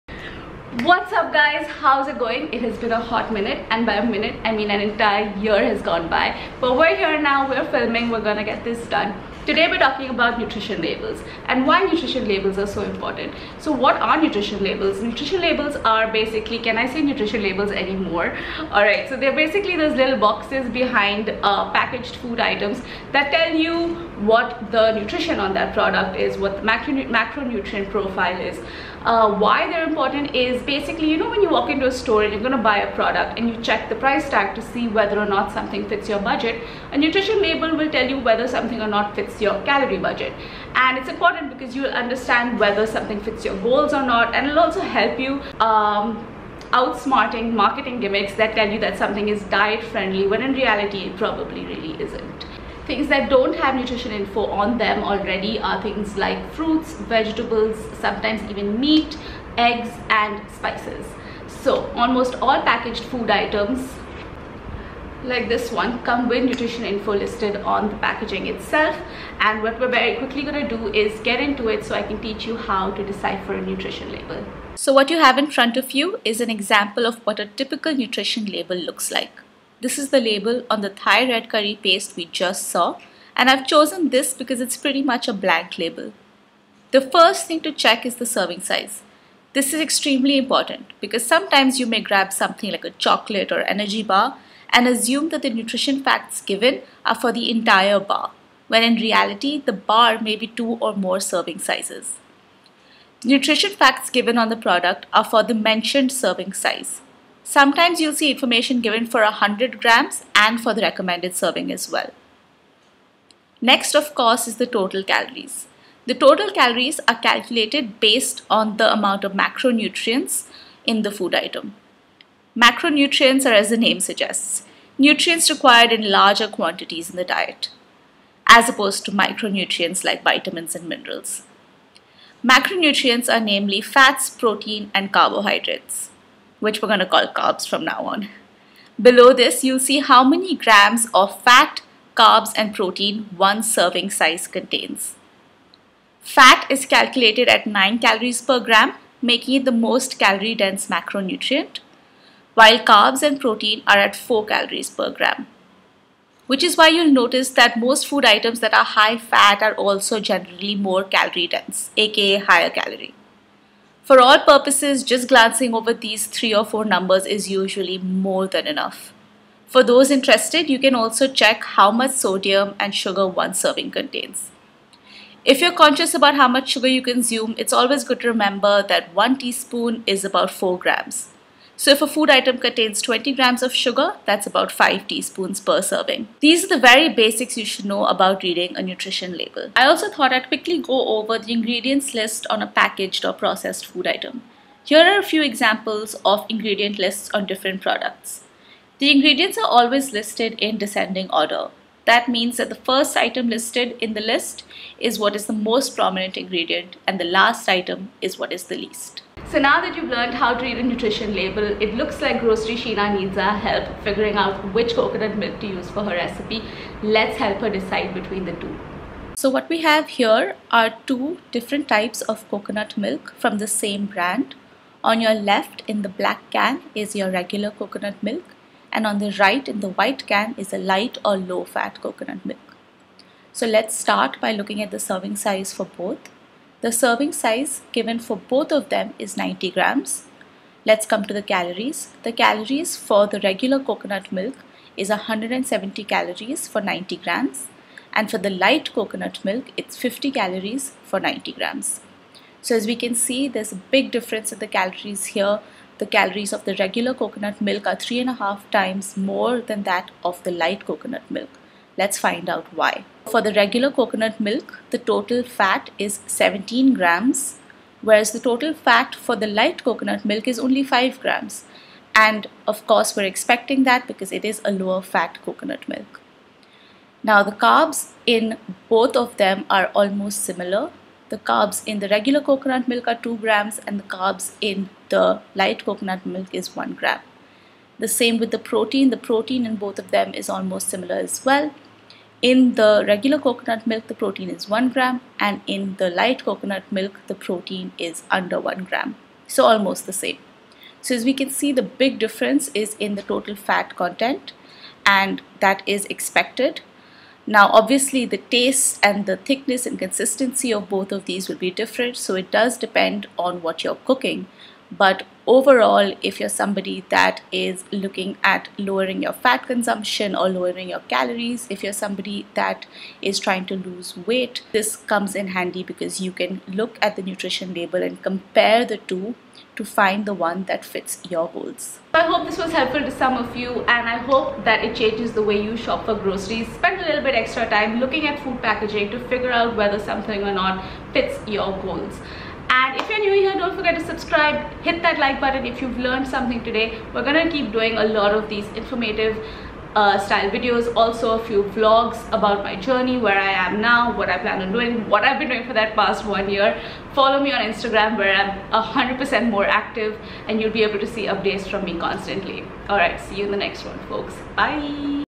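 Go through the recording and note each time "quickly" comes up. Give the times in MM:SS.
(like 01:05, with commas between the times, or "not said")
01:10, 03:10.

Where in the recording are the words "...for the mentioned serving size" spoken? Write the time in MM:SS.
01:45.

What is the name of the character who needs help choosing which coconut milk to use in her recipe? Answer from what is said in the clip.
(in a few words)
Grocery Sheena.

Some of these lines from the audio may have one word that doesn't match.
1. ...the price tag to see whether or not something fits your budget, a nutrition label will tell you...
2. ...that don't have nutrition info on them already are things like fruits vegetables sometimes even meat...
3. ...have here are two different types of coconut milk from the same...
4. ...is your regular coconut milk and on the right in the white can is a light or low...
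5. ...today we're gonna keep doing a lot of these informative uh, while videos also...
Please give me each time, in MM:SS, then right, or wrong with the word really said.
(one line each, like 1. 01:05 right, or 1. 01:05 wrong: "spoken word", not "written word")
1. 00:33 right
2. 00:53 right
3. 03:39 right
4. 03:46 right
5. 05:46 wrong: "style", not "while".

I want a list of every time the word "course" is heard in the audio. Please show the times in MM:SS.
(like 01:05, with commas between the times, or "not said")
01:54, 04:32.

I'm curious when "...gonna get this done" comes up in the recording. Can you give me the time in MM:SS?
00:08.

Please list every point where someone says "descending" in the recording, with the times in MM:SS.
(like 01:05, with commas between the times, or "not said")
03:20.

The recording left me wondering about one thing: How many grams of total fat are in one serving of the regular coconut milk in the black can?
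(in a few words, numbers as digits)
17 grams.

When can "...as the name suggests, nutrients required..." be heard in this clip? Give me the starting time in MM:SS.
02:03.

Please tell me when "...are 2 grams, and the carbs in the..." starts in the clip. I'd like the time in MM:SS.
04:43.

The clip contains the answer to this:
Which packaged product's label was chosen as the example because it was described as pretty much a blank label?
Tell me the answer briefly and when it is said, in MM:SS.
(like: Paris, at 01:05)
Thai red curry paste, at 01:20.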